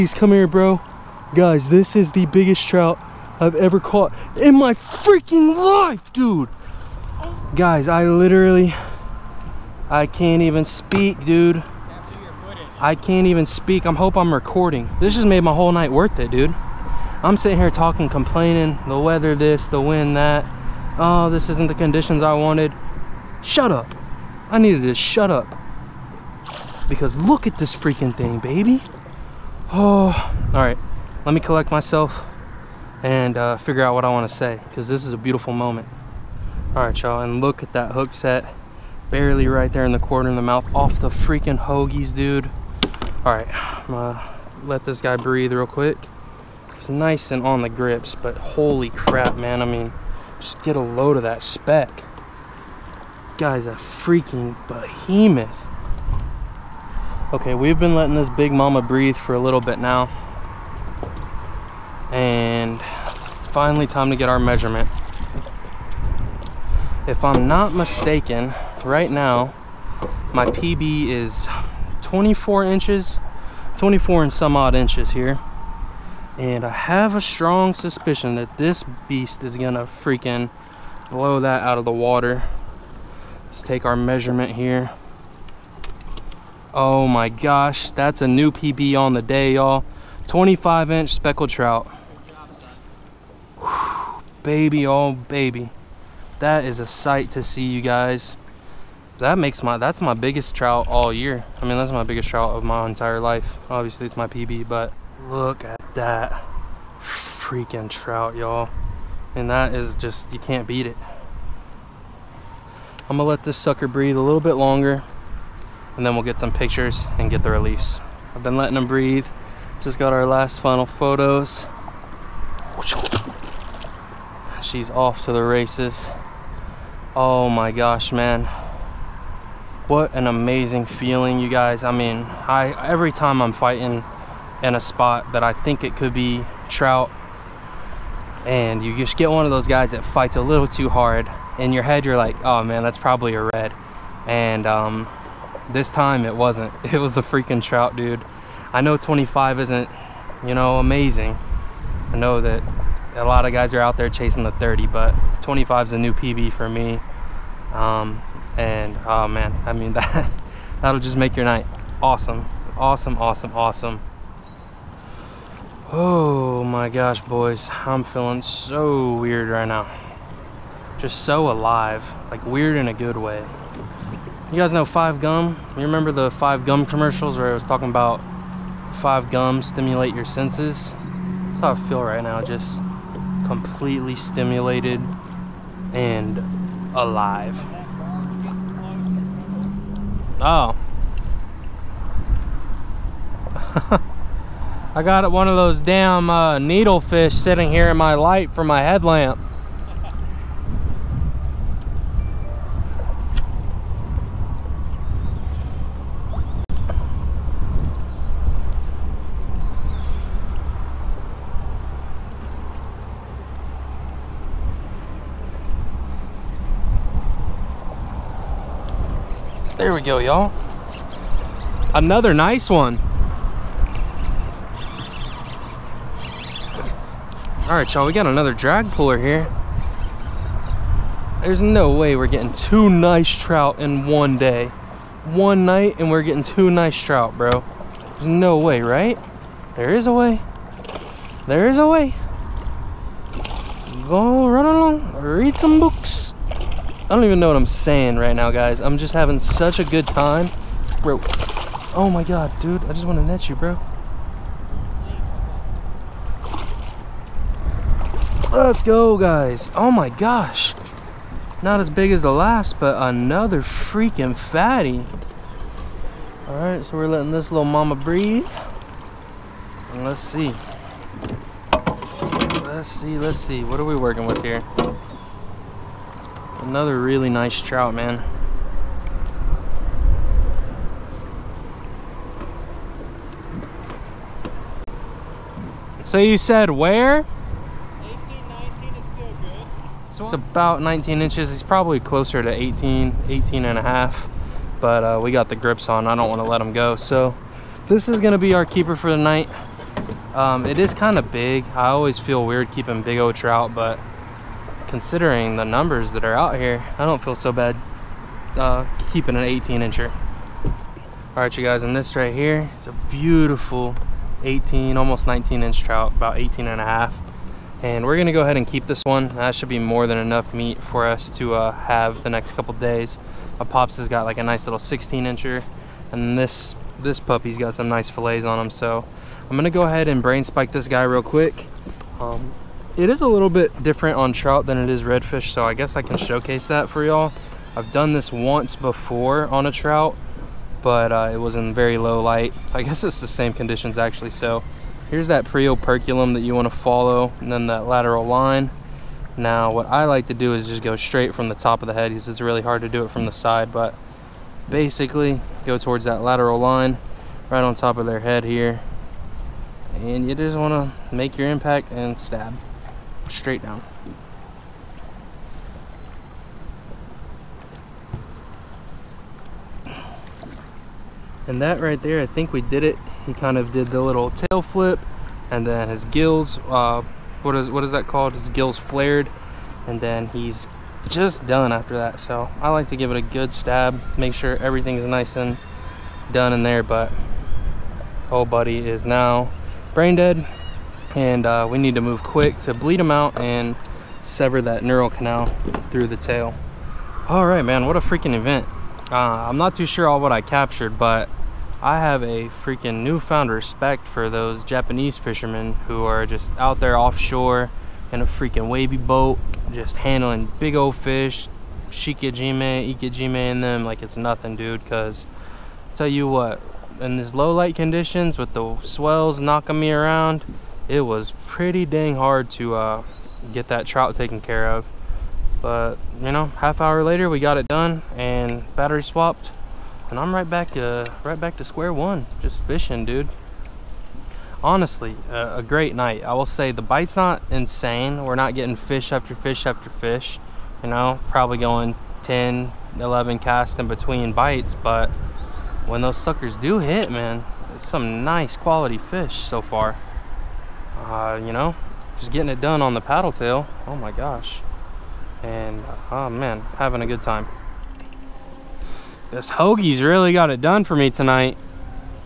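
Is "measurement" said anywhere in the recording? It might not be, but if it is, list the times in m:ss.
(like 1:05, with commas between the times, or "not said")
1:04, 1:23.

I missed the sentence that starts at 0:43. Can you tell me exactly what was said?
All right, I'm gonna let this guy breathe real quick.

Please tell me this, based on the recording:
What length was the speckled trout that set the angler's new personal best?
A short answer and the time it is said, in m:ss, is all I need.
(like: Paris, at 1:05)
25 inch, at 1:30.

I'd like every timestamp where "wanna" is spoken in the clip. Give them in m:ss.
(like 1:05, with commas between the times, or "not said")
5:46, 6:00.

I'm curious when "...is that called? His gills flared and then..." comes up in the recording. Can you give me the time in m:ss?
6:17.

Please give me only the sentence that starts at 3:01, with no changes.
That's how I feel right now, just completely stimulated and alive.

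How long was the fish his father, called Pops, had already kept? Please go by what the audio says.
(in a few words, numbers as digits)
16 inches.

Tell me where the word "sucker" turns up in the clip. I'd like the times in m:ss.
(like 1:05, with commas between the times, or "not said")
1:53, 7:26.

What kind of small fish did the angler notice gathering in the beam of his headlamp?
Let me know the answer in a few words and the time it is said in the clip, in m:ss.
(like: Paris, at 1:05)
needlefish, at 3:16.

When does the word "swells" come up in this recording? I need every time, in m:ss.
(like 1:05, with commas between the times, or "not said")
6:58.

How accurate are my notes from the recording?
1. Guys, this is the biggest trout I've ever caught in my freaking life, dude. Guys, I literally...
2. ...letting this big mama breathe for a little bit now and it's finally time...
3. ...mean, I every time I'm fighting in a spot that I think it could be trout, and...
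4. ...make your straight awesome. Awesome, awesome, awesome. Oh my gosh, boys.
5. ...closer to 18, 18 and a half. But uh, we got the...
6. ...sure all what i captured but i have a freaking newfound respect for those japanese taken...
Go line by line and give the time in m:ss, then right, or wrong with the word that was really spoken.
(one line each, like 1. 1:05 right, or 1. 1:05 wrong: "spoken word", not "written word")
1. 0:01 right
2. 0:57 right
3. 2:11 right
4. 2:41 wrong: "night", not "straight"
5. 4:52 right
6. 6:39 wrong: "fishermen", not "taken".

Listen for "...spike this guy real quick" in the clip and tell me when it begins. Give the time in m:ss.
5:30.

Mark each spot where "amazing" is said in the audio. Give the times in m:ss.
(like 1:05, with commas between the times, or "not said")
2:10, 2:30.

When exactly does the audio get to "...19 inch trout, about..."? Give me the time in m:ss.
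5:15.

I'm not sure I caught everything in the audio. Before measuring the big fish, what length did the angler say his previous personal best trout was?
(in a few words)
24 inches.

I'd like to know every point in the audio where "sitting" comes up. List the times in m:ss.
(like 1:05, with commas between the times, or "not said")
0:17, 3:17.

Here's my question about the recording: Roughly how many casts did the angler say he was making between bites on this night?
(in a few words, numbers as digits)
10 or 11.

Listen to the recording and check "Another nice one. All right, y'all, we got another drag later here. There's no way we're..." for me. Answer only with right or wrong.
wrong.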